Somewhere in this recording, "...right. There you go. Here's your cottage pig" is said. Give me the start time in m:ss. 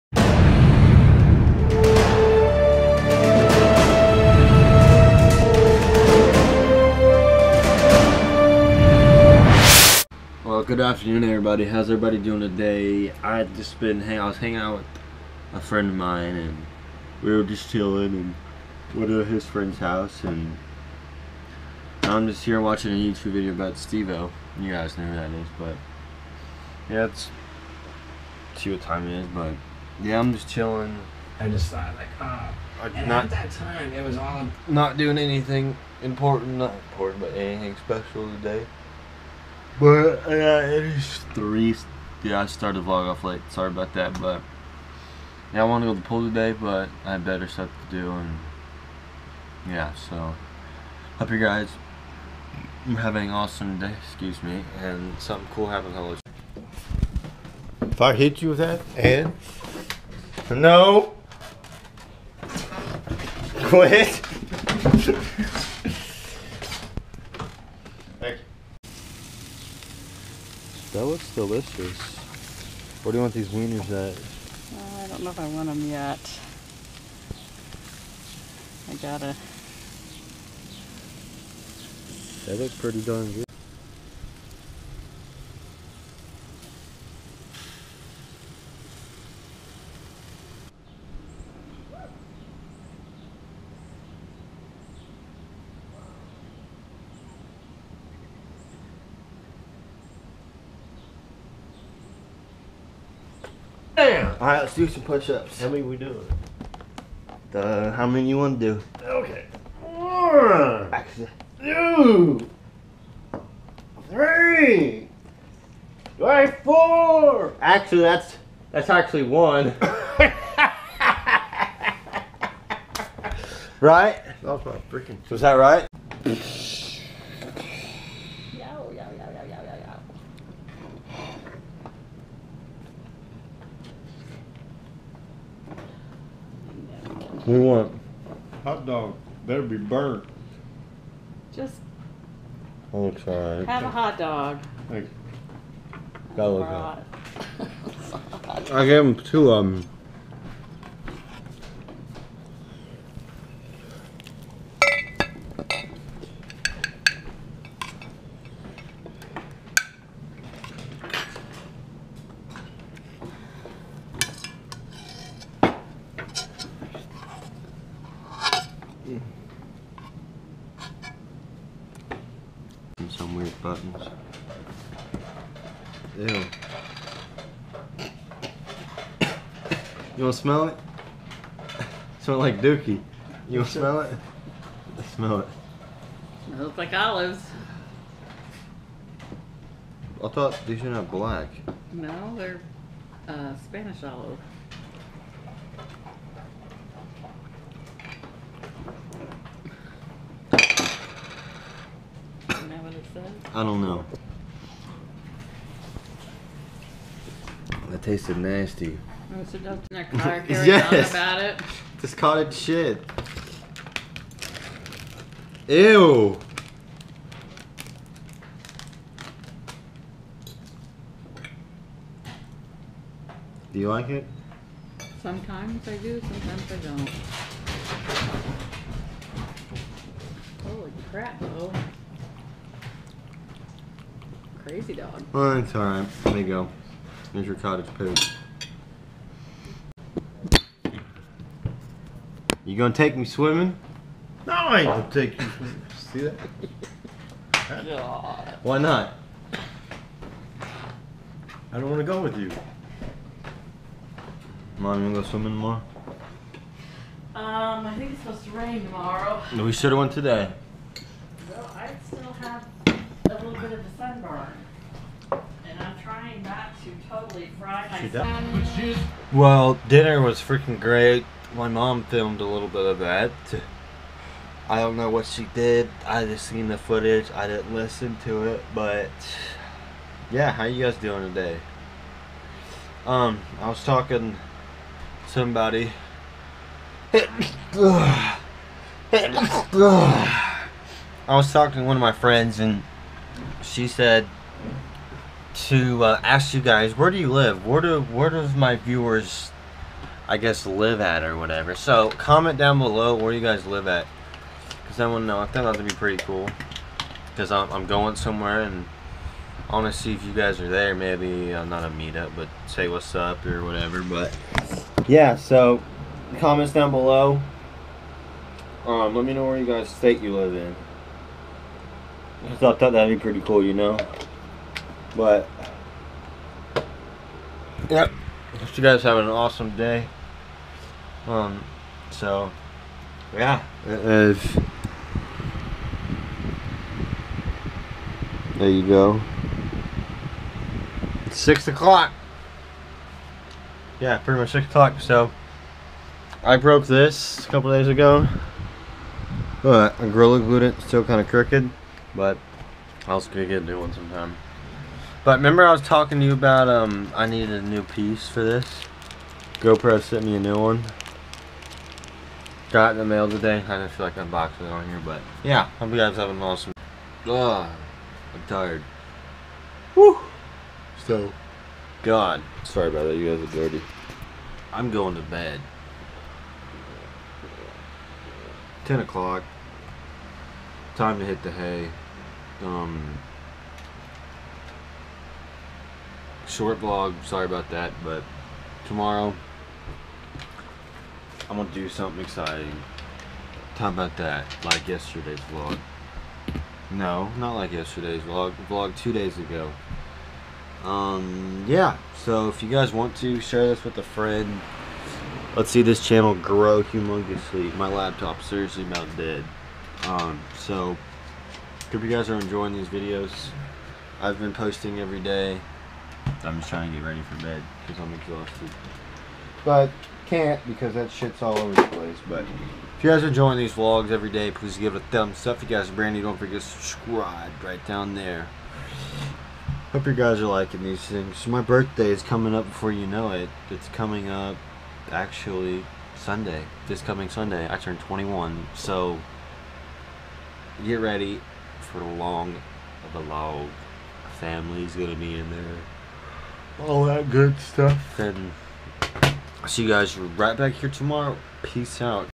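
3:55.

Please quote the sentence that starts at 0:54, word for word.
Excuse me, and something cool happens.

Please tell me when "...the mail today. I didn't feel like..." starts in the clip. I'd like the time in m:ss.
6:02.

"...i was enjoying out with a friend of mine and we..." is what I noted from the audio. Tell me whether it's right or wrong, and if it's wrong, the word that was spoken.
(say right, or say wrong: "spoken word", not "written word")
wrong: "hanging", not "enjoying".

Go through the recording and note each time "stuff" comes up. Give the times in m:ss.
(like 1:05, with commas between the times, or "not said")
0:47, 7:27.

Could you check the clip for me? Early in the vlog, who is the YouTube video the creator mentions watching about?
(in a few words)
Steve-O.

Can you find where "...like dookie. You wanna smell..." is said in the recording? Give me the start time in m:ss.
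3:02.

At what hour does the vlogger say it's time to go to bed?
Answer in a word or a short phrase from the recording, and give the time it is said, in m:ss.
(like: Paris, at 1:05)
10 o'clock, at 6:18.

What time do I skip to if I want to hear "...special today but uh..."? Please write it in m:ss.
0:37.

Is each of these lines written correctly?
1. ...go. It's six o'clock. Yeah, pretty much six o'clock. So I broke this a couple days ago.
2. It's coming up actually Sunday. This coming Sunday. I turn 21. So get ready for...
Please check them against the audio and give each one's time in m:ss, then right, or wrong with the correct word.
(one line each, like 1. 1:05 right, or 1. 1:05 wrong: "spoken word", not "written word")
1. 5:38 right
2. 7:13 right.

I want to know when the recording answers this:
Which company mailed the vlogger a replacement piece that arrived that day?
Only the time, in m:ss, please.
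5:59.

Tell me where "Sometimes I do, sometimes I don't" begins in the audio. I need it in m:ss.
3:45.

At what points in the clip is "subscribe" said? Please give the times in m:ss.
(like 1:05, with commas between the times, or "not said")
7:06.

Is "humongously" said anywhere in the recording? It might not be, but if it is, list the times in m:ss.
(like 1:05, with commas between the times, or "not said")
6:46.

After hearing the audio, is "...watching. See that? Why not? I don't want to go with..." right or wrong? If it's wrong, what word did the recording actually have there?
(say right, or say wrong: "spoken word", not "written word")
wrong: "swimming", not "watching".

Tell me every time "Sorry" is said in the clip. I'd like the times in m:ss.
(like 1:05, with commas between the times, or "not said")
0:43, 6:12, 6:27.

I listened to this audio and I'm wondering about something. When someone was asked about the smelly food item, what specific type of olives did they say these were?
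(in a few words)
Spanish olives.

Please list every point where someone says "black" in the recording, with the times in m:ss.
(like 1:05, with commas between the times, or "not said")
3:11.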